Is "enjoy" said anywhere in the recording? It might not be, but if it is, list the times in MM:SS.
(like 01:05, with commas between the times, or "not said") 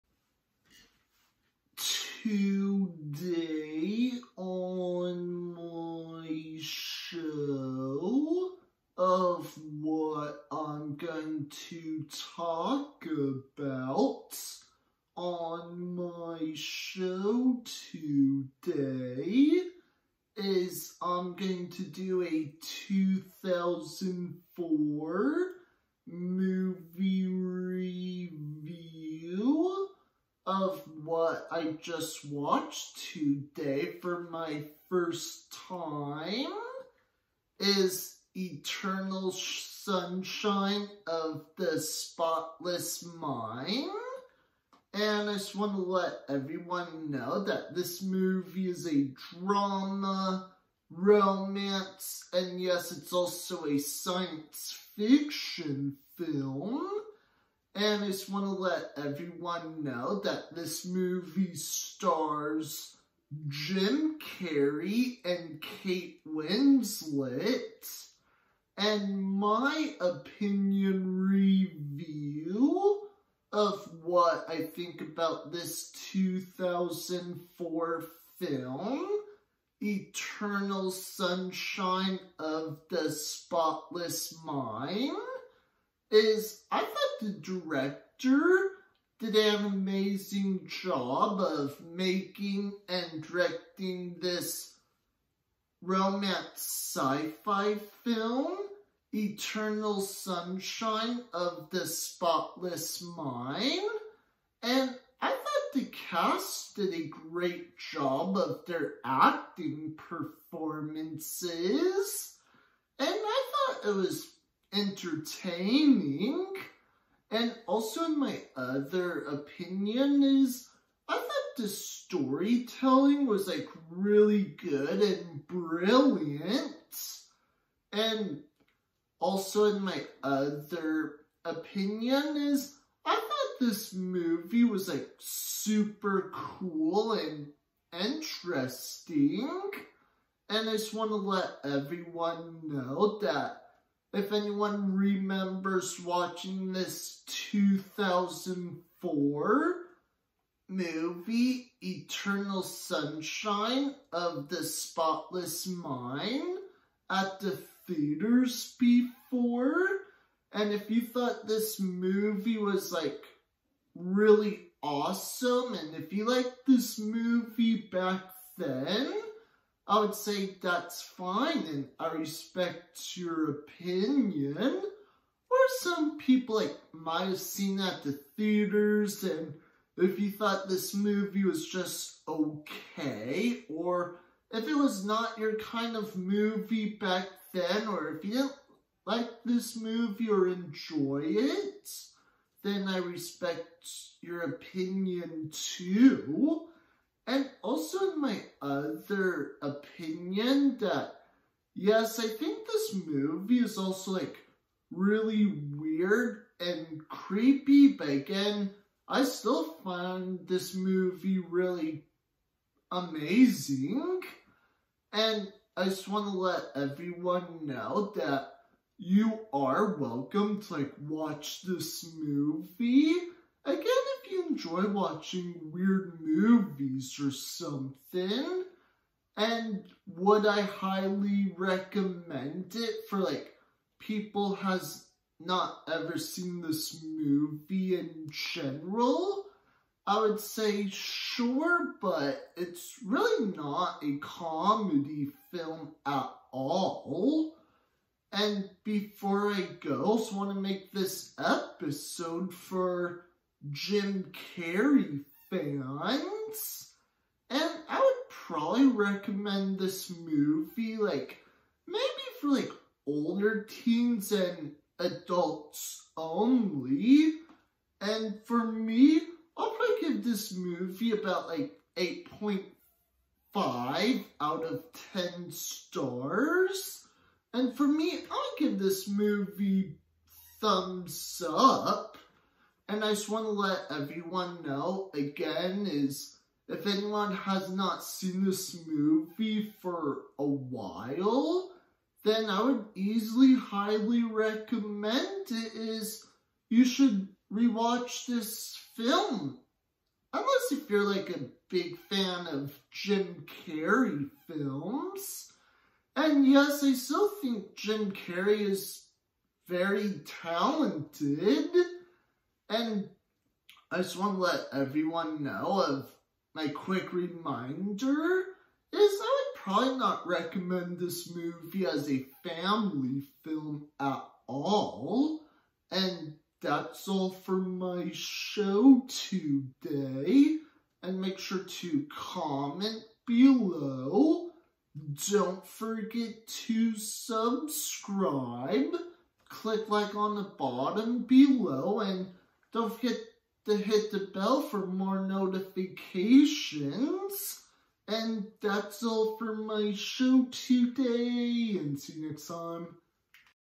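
03:10, 03:44.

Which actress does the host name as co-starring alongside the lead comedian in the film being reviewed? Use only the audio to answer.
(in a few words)
Kate Winslet.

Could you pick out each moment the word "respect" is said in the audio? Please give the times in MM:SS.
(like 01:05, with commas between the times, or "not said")
02:52, 03:12.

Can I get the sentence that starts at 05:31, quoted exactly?
And make sure to comment below.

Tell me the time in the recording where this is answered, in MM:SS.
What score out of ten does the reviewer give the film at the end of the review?
04:31.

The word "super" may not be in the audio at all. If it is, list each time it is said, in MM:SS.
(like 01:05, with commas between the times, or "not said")
02:15.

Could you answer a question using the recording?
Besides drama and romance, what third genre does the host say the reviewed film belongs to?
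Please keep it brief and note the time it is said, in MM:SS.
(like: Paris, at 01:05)
science fiction, at 00:53.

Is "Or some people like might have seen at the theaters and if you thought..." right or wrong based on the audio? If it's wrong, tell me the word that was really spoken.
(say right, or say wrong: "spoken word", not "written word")
right.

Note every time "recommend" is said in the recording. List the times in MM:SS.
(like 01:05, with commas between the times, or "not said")
03:51, 04:18, 04:54, 05:20.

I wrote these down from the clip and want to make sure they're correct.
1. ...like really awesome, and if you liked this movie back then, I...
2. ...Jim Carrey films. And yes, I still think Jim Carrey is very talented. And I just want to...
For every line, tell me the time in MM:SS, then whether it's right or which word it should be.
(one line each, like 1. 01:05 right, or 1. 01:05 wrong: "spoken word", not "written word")
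1. 02:42 right
2. 05:02 right.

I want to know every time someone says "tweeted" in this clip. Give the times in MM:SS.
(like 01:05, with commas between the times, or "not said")
not said.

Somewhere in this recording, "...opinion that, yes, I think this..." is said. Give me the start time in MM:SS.
03:19.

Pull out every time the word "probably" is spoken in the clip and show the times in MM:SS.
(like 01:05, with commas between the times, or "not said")
04:18, 04:29, 05:19.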